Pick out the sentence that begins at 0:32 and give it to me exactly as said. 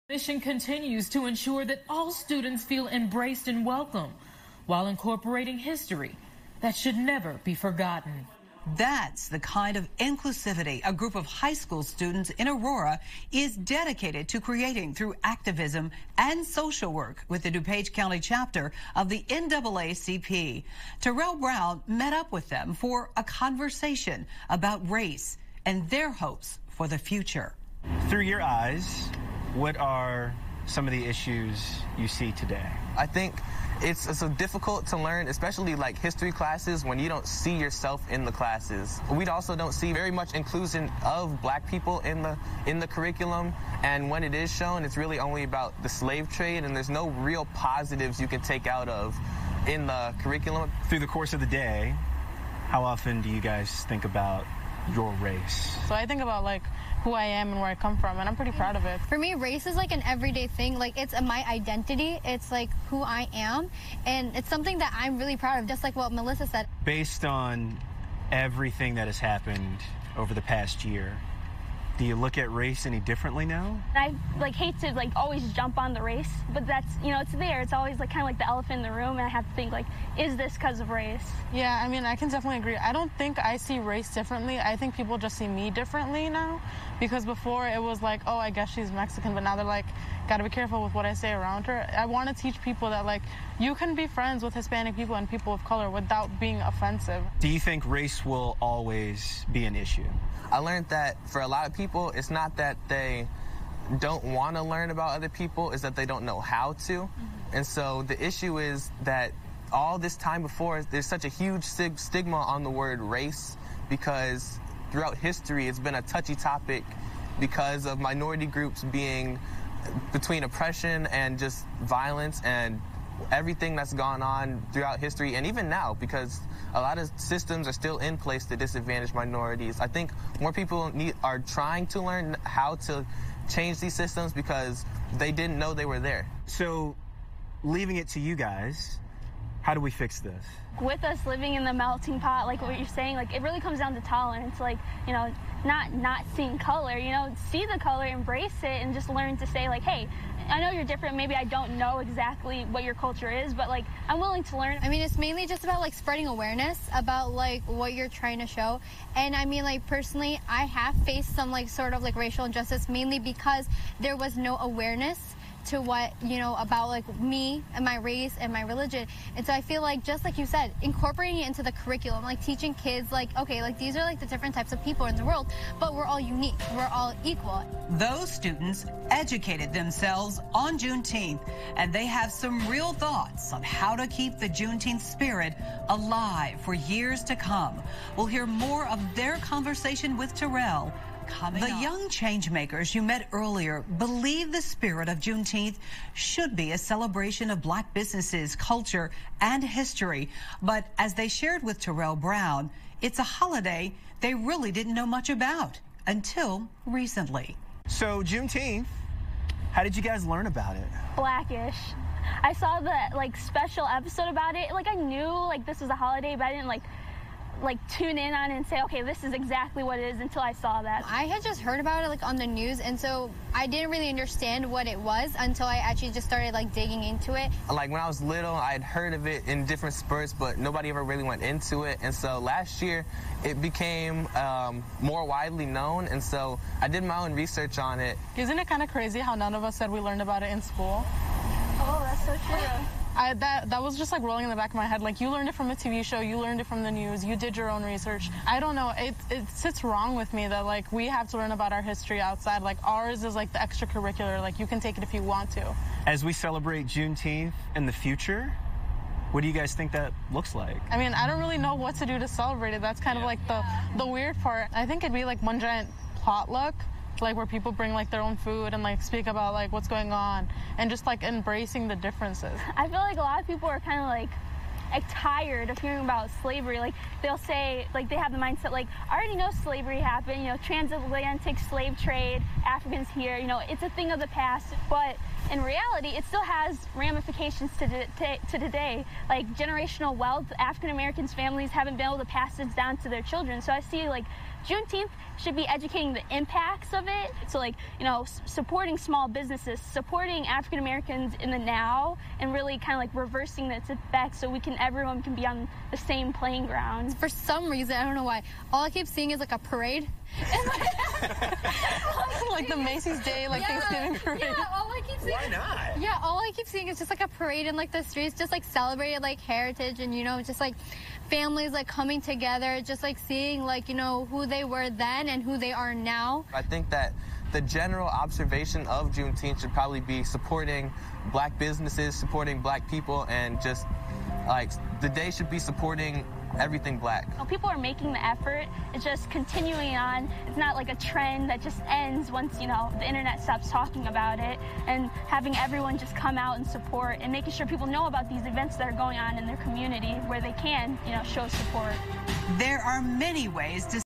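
I think it's, it's so difficult to learn, especially like history classes, when you don't see yourself in the classes.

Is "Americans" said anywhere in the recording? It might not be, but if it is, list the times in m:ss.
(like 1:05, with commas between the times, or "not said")
4:50, 5:00.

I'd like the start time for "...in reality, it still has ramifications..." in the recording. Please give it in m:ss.
4:45.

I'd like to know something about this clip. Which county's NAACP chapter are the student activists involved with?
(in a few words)
DuPage County.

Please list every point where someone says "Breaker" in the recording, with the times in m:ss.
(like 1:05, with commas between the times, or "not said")
not said.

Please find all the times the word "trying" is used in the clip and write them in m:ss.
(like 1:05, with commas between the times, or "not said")
2:11, 2:38.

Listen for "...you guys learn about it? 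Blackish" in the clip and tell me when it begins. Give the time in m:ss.
3:29.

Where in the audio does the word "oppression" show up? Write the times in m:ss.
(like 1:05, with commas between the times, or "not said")
2:00.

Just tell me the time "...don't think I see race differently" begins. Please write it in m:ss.
1:22.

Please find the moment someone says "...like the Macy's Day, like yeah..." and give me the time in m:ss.
5:12.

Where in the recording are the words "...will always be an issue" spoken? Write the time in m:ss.
1:38.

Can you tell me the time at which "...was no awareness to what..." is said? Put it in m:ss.
2:44.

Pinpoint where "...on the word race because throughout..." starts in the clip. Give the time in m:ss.
1:52.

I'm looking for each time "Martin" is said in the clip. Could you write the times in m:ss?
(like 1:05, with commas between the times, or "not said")
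not said.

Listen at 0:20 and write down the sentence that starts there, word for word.
Terrell Brown met up with them for a conversation about race and their hopes for the future.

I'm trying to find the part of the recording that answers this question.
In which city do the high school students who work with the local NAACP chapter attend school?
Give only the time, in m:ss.
0:12.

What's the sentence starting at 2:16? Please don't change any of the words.
So leaving it to you guys how do we fix this?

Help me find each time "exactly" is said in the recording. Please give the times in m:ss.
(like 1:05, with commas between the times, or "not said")
2:31, 3:39.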